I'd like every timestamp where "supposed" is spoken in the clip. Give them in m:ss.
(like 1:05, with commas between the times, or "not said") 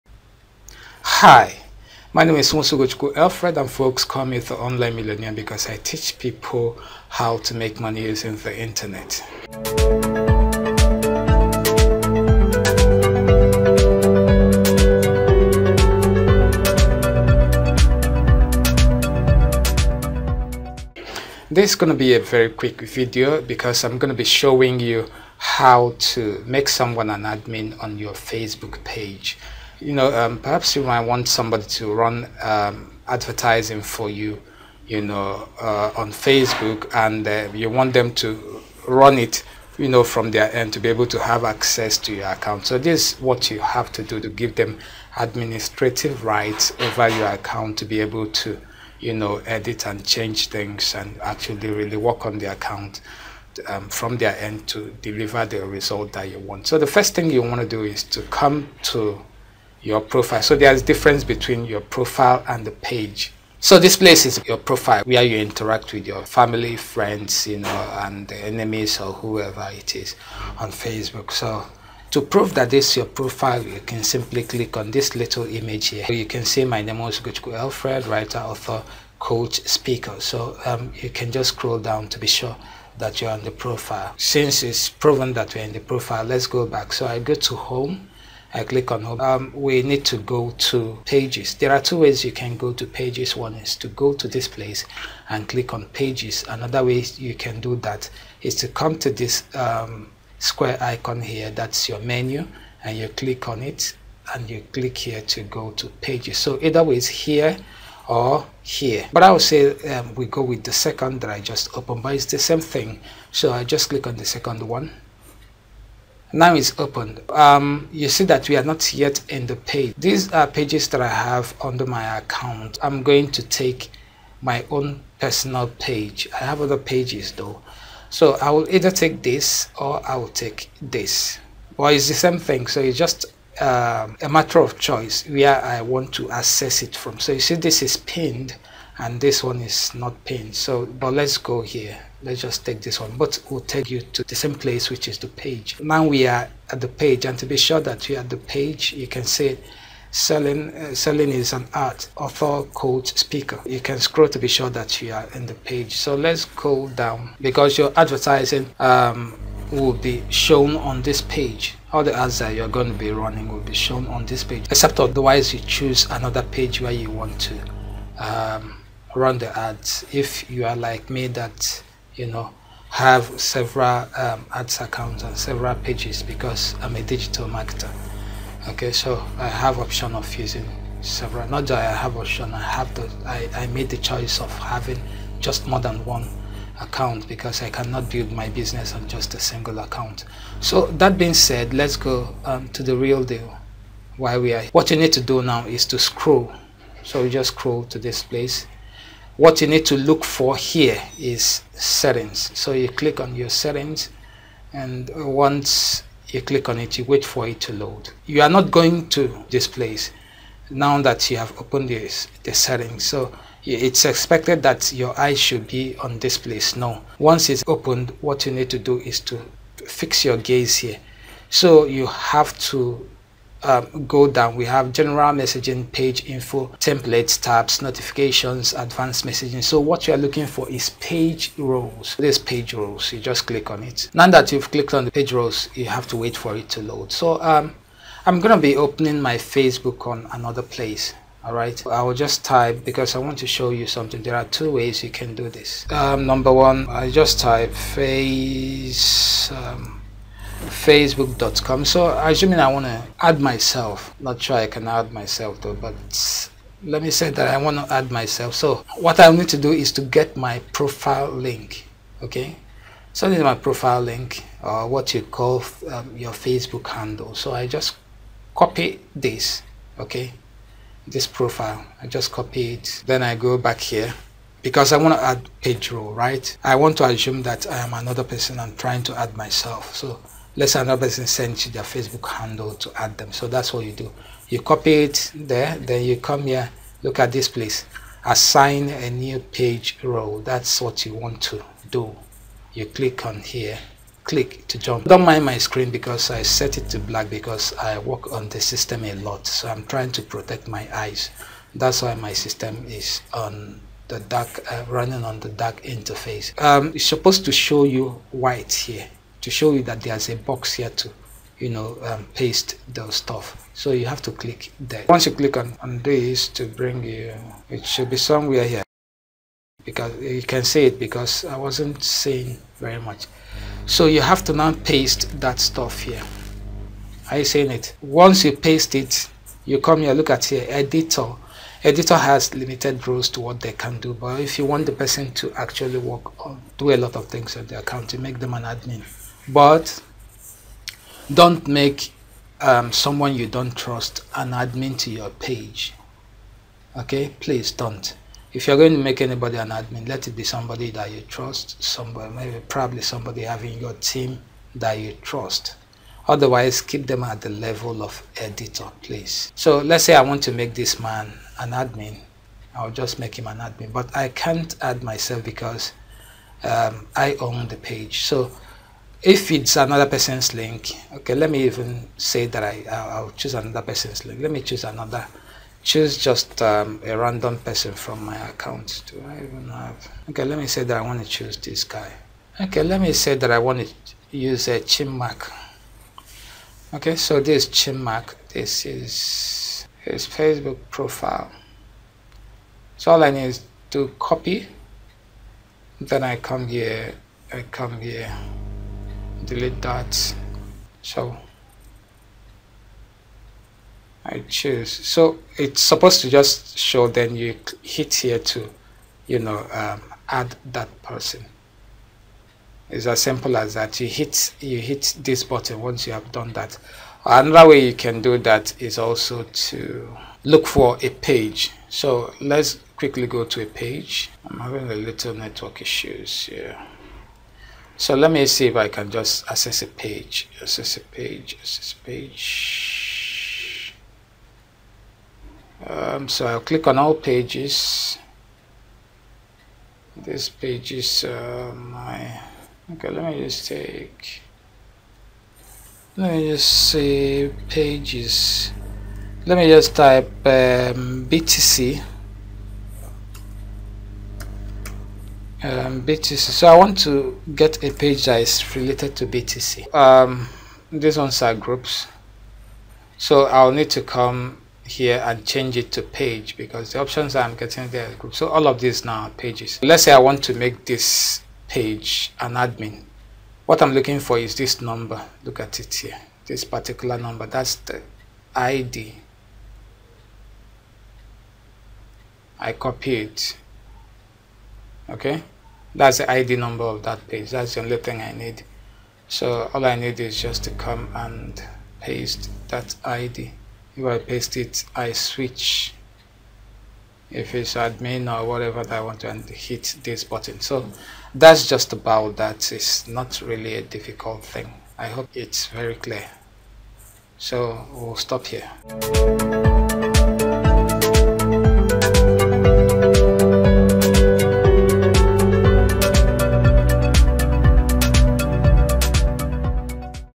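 5:07, 6:45.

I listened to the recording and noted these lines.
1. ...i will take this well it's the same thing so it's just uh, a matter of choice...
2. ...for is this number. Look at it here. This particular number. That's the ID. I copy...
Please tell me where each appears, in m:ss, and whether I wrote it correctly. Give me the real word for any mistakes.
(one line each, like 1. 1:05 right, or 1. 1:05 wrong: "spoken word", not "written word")
1. 2:10 right
2. 7:54 right.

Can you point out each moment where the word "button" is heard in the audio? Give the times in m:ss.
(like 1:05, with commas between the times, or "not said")
6:55, 8:20.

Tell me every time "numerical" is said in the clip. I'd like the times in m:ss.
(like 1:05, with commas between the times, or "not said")
not said.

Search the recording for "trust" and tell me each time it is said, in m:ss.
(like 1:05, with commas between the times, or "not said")
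5:43, 5:51, 5:55.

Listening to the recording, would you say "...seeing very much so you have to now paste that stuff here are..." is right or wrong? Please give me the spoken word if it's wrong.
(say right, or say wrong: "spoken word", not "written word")
right.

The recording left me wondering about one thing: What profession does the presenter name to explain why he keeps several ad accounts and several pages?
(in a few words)
digital marketer.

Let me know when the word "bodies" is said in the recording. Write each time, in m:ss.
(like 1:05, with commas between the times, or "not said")
not said.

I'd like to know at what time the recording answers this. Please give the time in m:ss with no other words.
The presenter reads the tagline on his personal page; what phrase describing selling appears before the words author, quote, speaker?
2:30.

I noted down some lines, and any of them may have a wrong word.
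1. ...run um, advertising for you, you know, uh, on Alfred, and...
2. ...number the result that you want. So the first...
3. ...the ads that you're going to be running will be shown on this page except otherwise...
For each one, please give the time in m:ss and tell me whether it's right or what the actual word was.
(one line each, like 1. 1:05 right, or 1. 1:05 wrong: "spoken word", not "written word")
1. 0:31 wrong: "Facebook", not "Alfred"
2. 0:55 wrong: "deliver", not "number"
3. 2:42 right.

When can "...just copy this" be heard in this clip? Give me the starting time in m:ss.
4:27.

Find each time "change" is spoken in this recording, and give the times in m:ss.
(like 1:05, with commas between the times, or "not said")
0:50, 7:45.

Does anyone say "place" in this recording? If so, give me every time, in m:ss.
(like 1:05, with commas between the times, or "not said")
1:03, 1:34, 2:24, 3:18, 3:29, 3:36, 4:00, 4:47.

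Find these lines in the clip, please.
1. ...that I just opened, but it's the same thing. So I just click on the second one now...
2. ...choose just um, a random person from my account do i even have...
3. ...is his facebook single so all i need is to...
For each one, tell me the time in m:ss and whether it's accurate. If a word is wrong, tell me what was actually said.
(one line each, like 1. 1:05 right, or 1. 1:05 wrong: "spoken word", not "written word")
1. 1:51 right
2. 6:15 right
3. 6:28 wrong: "profile", not "single".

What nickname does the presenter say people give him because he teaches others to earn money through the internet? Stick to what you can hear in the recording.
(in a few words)
the online millionaire.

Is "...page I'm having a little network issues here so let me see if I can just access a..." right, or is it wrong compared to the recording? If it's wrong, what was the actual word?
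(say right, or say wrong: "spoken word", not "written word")
right.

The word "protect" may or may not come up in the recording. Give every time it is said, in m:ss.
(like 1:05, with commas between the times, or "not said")
5:00.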